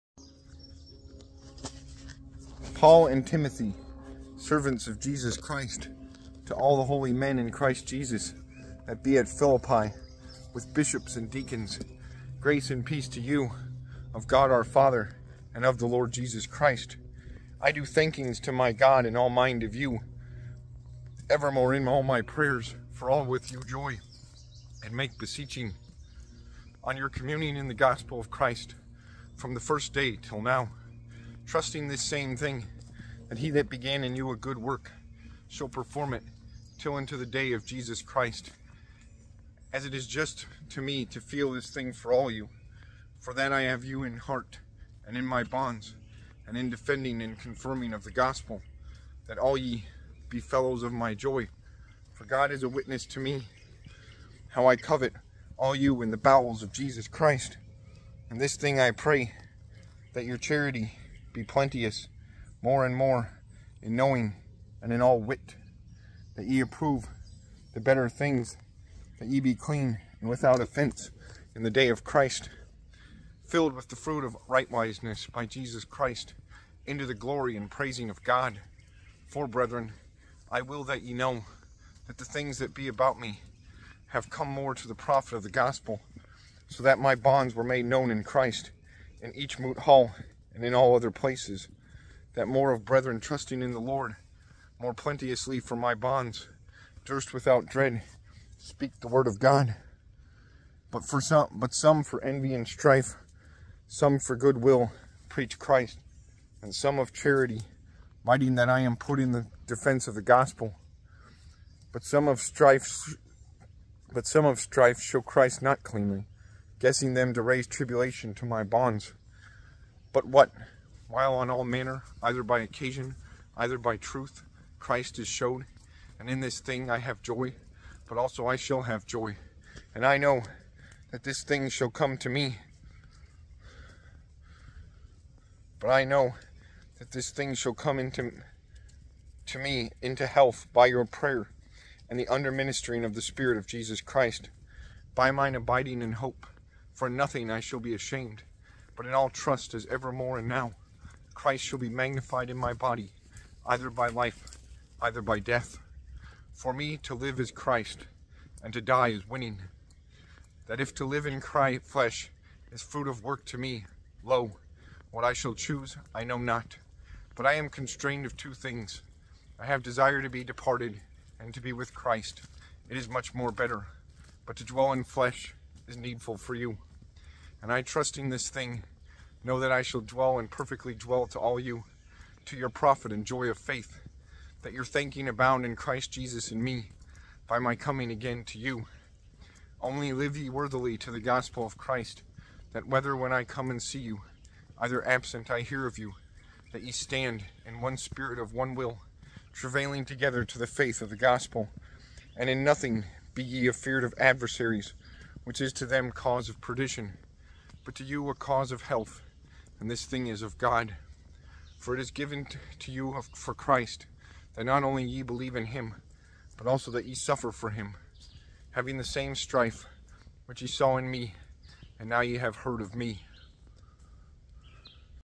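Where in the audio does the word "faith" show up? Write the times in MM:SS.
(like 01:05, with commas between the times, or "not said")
03:03, 03:20.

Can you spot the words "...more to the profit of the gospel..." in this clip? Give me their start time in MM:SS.
01:24.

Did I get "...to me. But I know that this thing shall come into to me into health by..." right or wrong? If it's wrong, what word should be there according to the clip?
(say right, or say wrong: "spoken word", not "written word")
right.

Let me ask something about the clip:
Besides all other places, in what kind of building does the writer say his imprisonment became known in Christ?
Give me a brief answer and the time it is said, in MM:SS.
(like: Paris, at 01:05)
moot hall, at 01:29.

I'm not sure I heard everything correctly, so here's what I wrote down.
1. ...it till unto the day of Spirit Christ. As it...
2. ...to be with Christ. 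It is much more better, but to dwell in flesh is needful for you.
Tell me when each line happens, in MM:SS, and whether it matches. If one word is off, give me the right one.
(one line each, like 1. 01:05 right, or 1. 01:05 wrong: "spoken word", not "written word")
1. 00:36 wrong: "Jesus", not "Spirit"
2. 02:51 right.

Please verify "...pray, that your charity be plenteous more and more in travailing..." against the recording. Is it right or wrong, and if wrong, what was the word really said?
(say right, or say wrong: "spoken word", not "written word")
wrong: "knowing", not "travailing".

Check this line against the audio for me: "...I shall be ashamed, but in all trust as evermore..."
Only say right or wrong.
right.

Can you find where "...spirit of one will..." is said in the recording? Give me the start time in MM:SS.
03:17.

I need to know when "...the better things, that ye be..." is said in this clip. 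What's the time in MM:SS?
01:07.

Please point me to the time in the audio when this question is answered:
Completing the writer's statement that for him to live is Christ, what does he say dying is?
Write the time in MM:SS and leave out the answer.
02:39.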